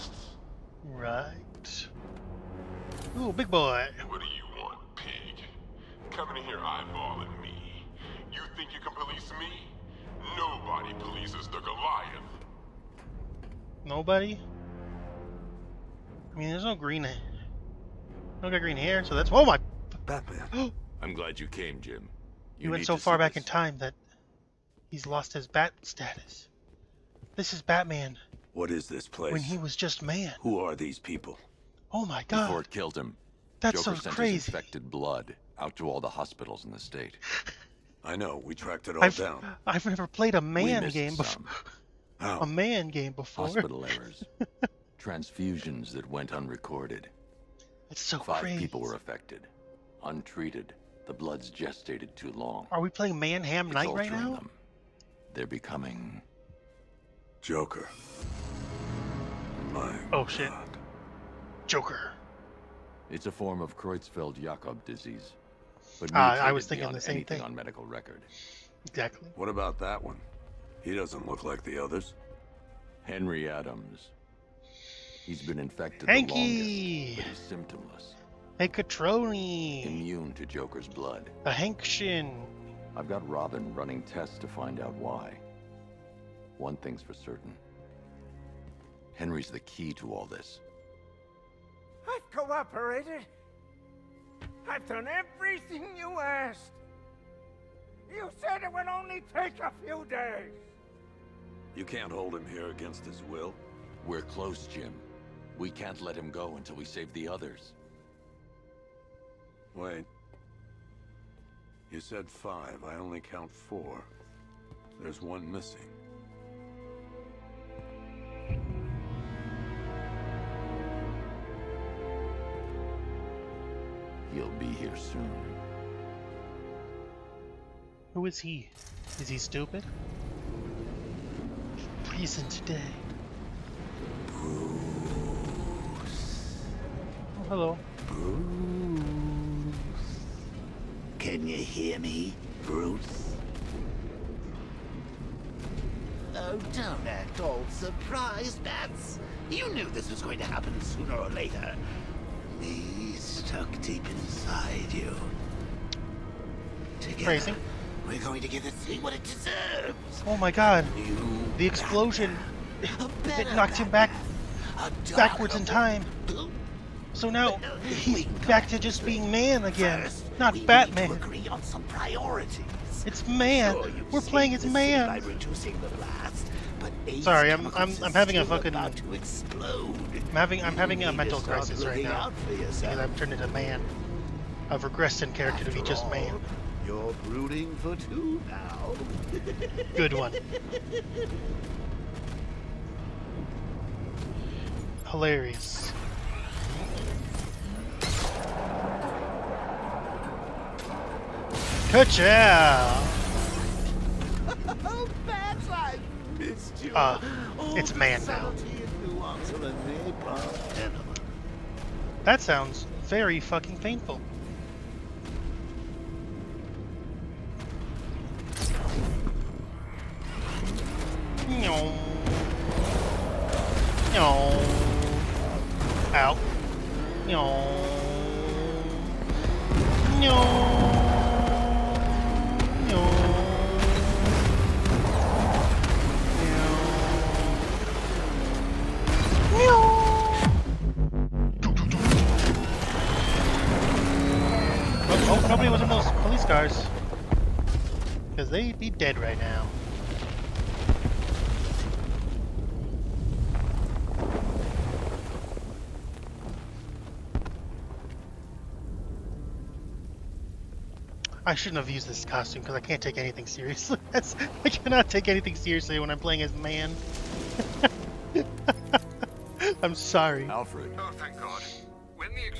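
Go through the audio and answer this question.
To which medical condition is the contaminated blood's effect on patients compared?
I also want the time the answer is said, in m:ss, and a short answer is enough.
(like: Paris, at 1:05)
Creutzfeldt-Jakob disease, at 1:03.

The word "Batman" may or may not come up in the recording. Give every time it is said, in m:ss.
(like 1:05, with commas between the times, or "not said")
0:20, 0:27, 2:50.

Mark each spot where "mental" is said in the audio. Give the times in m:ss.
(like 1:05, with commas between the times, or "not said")
3:01.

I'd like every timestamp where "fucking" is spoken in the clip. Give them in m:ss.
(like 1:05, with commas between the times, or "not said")
2:58, 3:33.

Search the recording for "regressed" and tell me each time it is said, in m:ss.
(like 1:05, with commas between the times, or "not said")
3:04.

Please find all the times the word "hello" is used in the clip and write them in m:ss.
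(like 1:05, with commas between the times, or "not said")
2:17.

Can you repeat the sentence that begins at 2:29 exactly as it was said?
You knew this was going to happen sooner or later.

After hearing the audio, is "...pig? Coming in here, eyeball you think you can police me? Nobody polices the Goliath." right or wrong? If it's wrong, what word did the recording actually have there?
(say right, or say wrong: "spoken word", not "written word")
right.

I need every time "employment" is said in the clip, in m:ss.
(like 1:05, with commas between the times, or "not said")
not said.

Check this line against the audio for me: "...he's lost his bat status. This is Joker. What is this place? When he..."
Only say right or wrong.
wrong.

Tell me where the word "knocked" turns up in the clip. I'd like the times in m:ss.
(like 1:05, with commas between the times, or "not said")
2:43.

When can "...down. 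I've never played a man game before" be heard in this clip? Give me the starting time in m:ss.
0:39.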